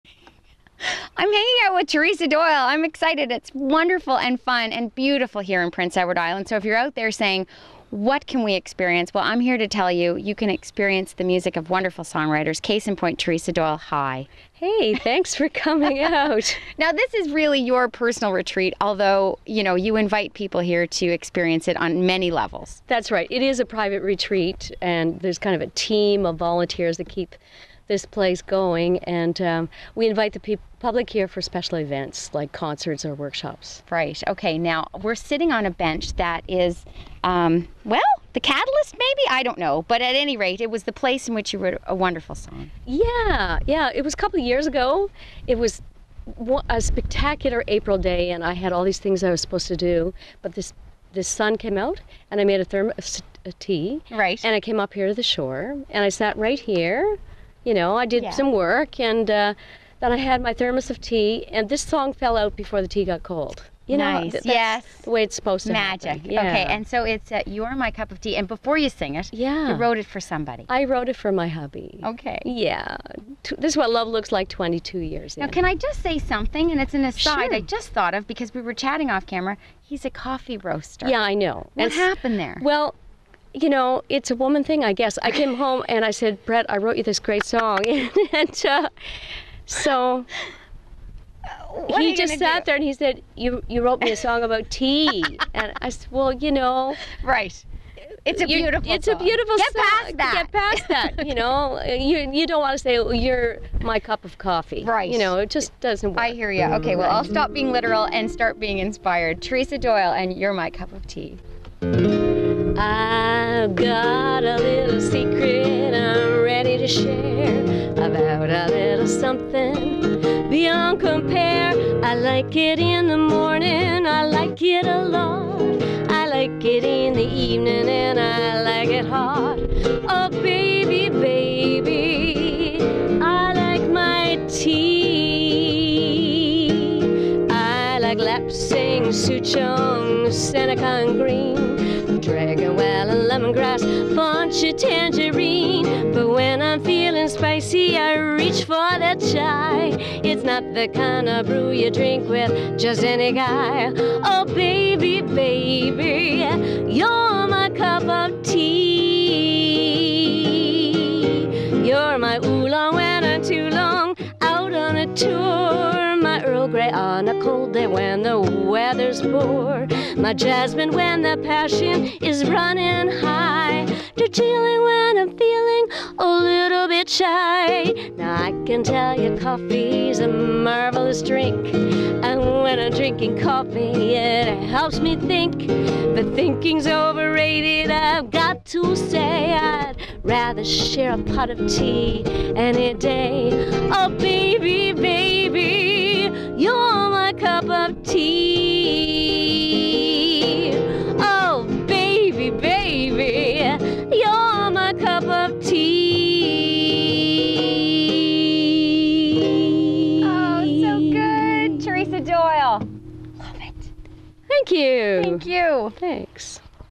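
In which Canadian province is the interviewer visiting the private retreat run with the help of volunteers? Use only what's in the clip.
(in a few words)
Prince Edward Island.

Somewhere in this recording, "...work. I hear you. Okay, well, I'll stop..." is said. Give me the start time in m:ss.
1:46.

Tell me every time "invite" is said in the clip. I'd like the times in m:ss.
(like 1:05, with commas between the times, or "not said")
0:19, 0:30.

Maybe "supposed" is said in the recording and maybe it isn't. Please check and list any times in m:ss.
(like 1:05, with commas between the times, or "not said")
0:49, 1:05.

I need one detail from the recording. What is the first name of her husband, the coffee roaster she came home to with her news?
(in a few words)
Brett.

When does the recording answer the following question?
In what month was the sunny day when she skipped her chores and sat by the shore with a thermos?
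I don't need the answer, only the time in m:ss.
0:47.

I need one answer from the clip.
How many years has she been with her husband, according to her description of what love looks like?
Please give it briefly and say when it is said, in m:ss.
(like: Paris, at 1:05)
22 years, at 1:14.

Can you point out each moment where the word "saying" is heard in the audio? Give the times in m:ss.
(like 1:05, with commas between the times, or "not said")
0:07.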